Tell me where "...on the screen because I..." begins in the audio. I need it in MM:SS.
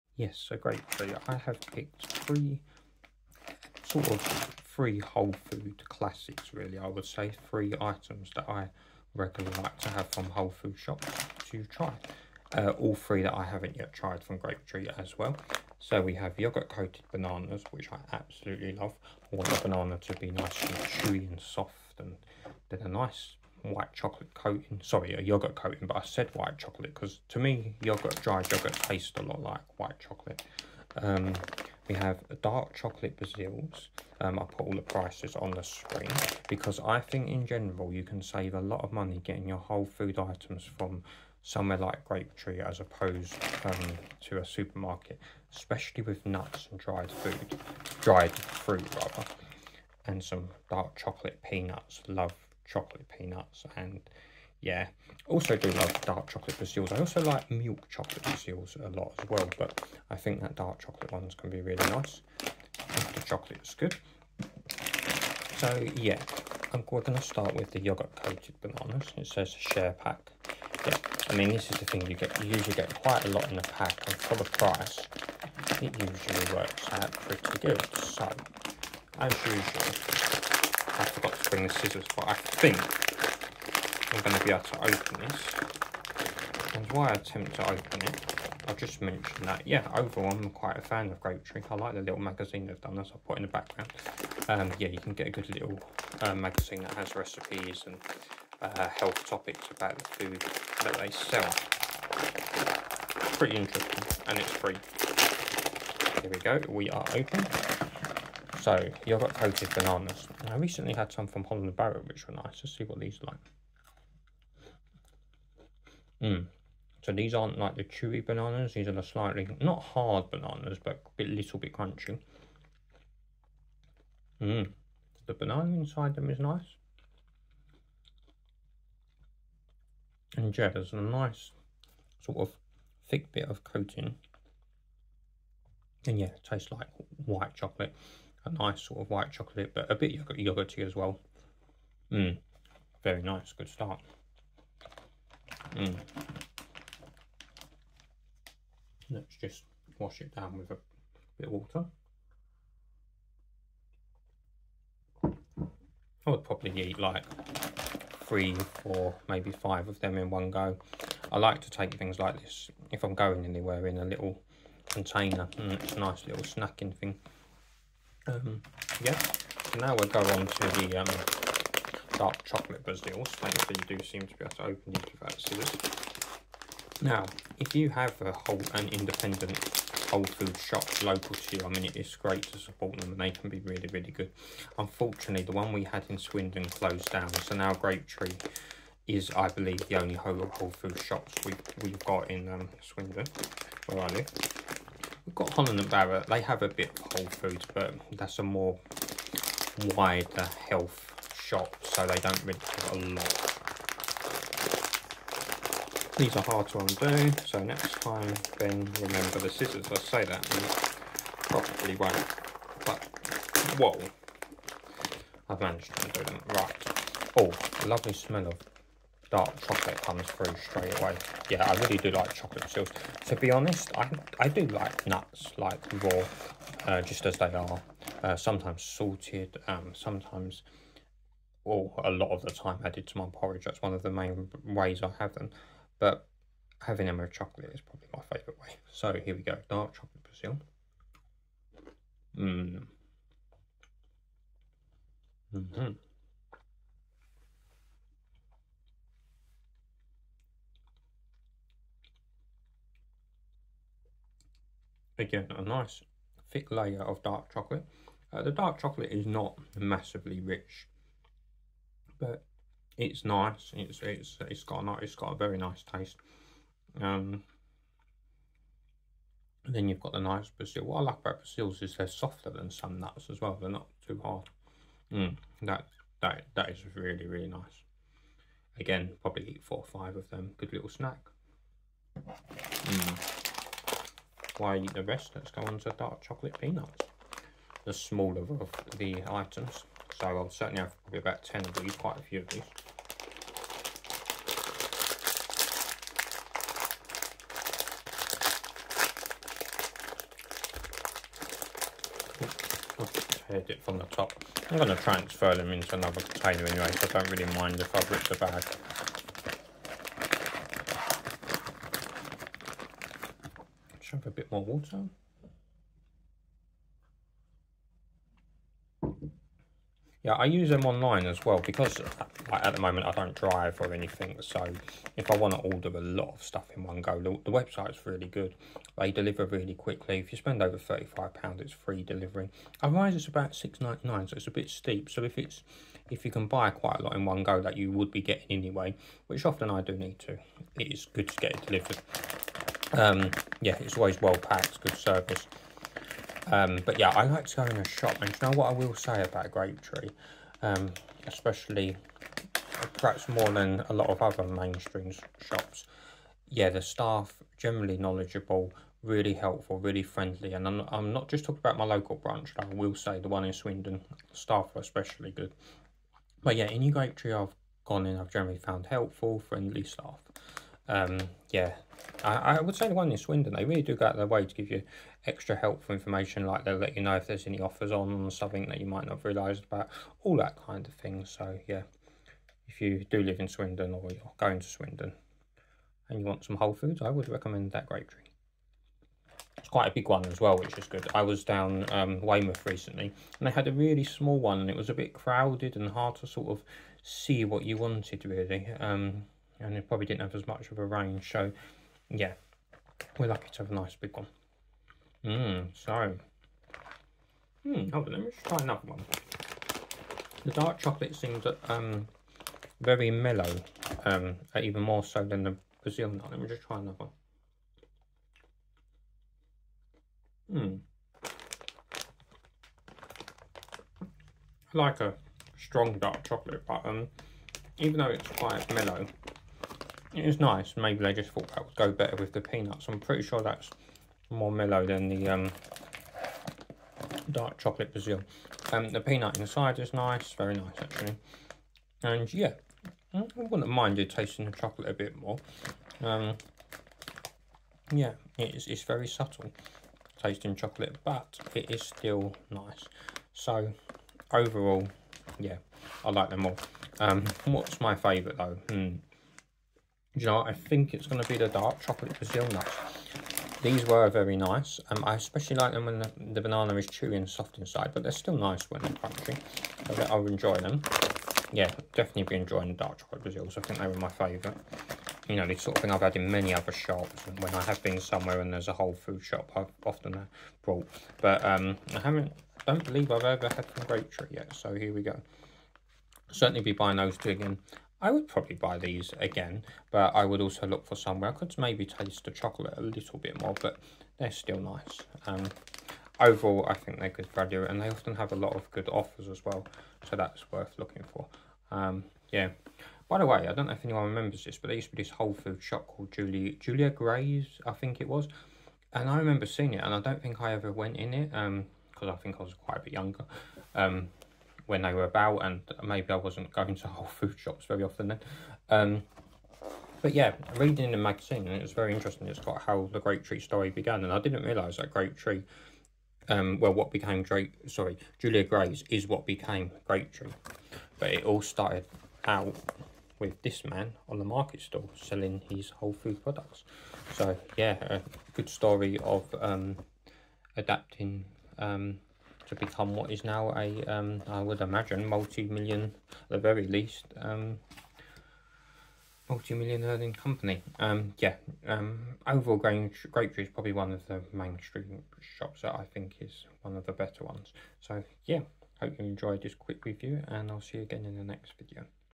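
00:35.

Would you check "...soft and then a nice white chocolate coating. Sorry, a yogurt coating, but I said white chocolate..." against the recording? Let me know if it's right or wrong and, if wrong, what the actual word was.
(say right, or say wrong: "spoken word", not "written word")
right.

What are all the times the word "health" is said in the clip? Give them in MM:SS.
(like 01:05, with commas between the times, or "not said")
01:38, 03:20.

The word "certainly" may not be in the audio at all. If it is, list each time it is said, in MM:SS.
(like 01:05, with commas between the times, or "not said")
04:50, 08:06.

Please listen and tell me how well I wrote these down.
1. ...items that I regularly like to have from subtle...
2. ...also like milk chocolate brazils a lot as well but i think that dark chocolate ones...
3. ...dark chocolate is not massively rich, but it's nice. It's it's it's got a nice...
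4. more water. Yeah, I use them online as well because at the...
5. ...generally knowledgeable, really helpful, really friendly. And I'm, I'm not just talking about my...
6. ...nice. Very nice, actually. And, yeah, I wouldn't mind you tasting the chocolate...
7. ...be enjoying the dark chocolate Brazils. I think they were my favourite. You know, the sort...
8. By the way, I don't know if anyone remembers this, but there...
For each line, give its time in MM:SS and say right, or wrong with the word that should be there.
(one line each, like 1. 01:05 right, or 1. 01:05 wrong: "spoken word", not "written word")
1. 00:07 wrong: "whole", not "subtle"
2. 00:56 right
3. 04:18 right
4. 05:14 right
5. 05:57 right
6. 07:19 right
7. 07:52 right
8. 08:23 right.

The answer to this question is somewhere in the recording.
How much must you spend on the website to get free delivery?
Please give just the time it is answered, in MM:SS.
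05:30.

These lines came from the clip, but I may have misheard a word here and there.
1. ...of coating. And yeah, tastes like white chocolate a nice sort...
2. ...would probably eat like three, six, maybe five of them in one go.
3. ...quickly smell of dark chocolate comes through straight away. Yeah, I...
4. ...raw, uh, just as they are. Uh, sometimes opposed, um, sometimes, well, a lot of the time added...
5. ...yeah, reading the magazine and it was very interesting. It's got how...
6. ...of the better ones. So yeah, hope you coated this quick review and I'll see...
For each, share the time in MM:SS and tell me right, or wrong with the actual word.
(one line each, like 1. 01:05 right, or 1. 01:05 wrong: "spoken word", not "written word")
1. 02:13 right
2. 02:36 wrong: "four", not "six"
3. 03:37 wrong: "lovely", not "quickly"
4. 03:46 wrong: "salted", not "opposed"
5. 08:40 right
6. 09:16 wrong: "enjoyed", not "coated".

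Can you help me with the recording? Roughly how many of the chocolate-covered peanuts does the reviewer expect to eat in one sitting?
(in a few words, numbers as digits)
10.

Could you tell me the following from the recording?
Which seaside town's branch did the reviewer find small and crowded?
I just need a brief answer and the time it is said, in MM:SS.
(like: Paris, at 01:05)
Weymouth, at 06:32.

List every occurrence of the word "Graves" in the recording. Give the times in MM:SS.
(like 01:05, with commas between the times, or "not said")
08:26, 08:48.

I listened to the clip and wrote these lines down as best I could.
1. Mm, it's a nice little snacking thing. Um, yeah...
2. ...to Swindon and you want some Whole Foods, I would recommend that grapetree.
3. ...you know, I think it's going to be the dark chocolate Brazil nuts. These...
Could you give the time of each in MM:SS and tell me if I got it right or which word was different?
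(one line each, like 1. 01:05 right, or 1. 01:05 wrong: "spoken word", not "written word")
1. 02:45 right
2. 06:24 right
3. 07:40 right.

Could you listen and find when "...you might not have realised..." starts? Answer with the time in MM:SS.
06:18.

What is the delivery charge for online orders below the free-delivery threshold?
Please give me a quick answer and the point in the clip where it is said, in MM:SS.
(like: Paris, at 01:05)
6.99, at 05:33.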